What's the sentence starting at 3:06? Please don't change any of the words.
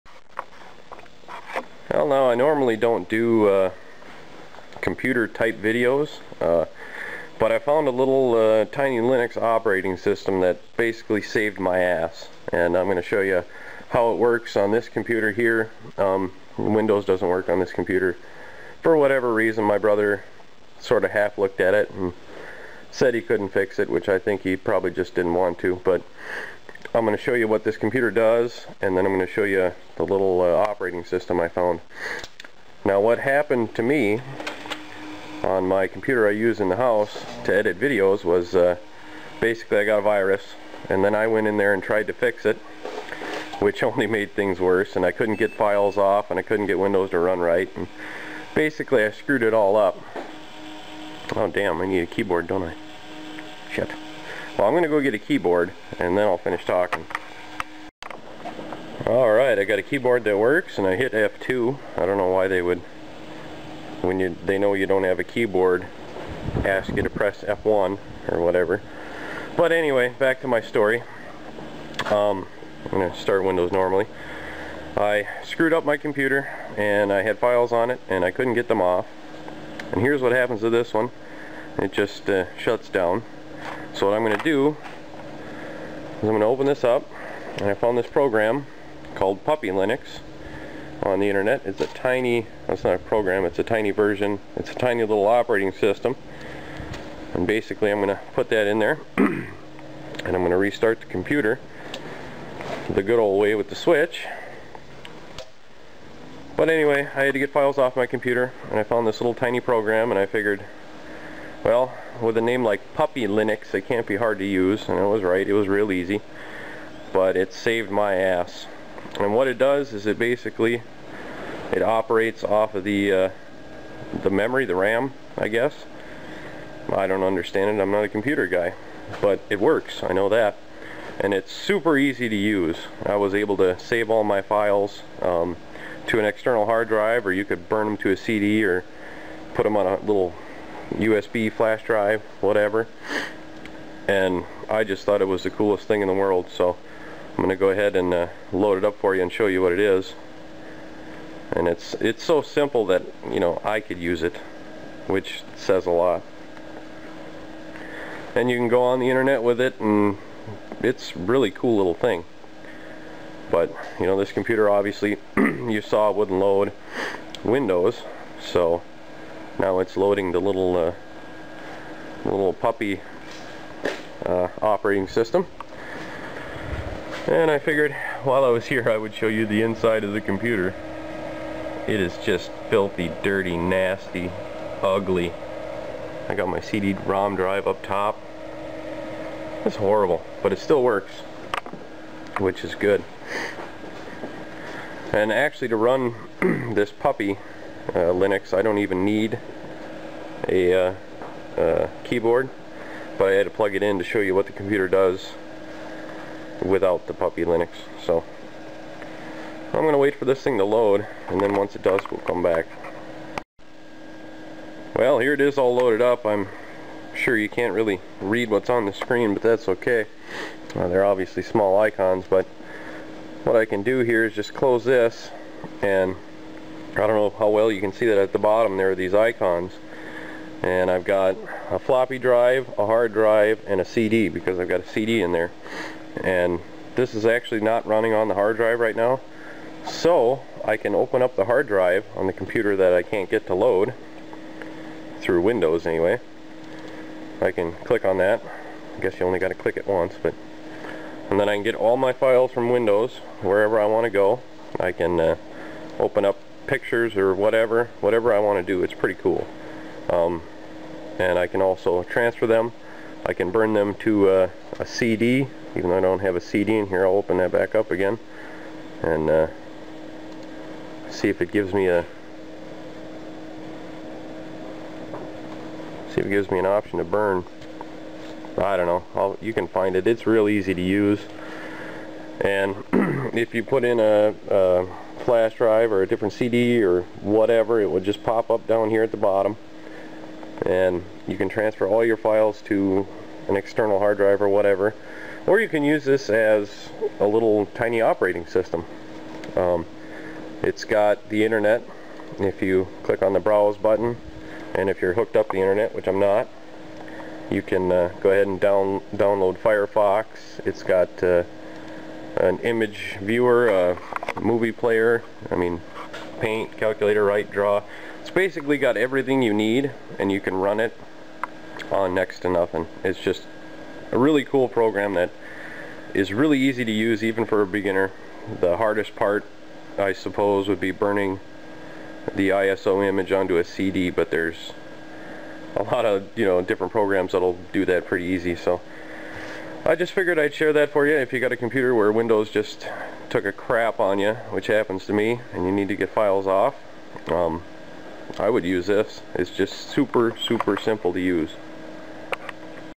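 I got my CD-ROM drive up top.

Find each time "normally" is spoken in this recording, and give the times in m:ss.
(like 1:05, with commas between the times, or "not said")
0:02, 1:13.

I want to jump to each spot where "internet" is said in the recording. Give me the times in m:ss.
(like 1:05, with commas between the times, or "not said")
1:31, 2:39, 5:01, 5:05.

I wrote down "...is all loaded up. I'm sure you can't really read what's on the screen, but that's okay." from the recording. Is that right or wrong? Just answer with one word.
right.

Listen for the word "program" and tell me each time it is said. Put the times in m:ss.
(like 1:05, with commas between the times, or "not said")
1:28, 1:32, 1:49, 5:24, 5:36.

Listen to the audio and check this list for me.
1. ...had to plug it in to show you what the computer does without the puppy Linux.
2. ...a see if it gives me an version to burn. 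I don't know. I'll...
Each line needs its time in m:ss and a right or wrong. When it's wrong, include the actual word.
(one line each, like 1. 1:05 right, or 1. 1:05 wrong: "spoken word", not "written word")
1. 3:23 right
2. 4:31 wrong: "option", not "version".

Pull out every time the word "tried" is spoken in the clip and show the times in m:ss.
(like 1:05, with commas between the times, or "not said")
0:41.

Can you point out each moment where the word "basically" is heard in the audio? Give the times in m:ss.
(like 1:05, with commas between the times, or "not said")
0:10, 0:39, 0:48, 1:37, 2:00, 5:18.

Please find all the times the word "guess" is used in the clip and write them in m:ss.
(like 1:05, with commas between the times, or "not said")
2:05, 4:09.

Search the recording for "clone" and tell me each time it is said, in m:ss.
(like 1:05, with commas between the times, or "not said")
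not said.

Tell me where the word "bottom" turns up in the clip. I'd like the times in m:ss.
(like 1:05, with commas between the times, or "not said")
3:48, 4:49.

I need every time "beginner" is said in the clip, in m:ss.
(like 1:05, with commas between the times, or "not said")
5:27.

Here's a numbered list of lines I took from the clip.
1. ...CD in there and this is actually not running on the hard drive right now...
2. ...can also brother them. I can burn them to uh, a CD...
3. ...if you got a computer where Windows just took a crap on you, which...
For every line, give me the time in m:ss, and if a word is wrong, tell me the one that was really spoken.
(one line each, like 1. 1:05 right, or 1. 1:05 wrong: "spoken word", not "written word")
1. 3:54 right
2. 4:21 wrong: "transfer", not "brother"
3. 5:41 right.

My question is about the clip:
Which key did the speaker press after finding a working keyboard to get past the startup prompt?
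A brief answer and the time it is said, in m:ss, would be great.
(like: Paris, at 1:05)
F2, at 1:01.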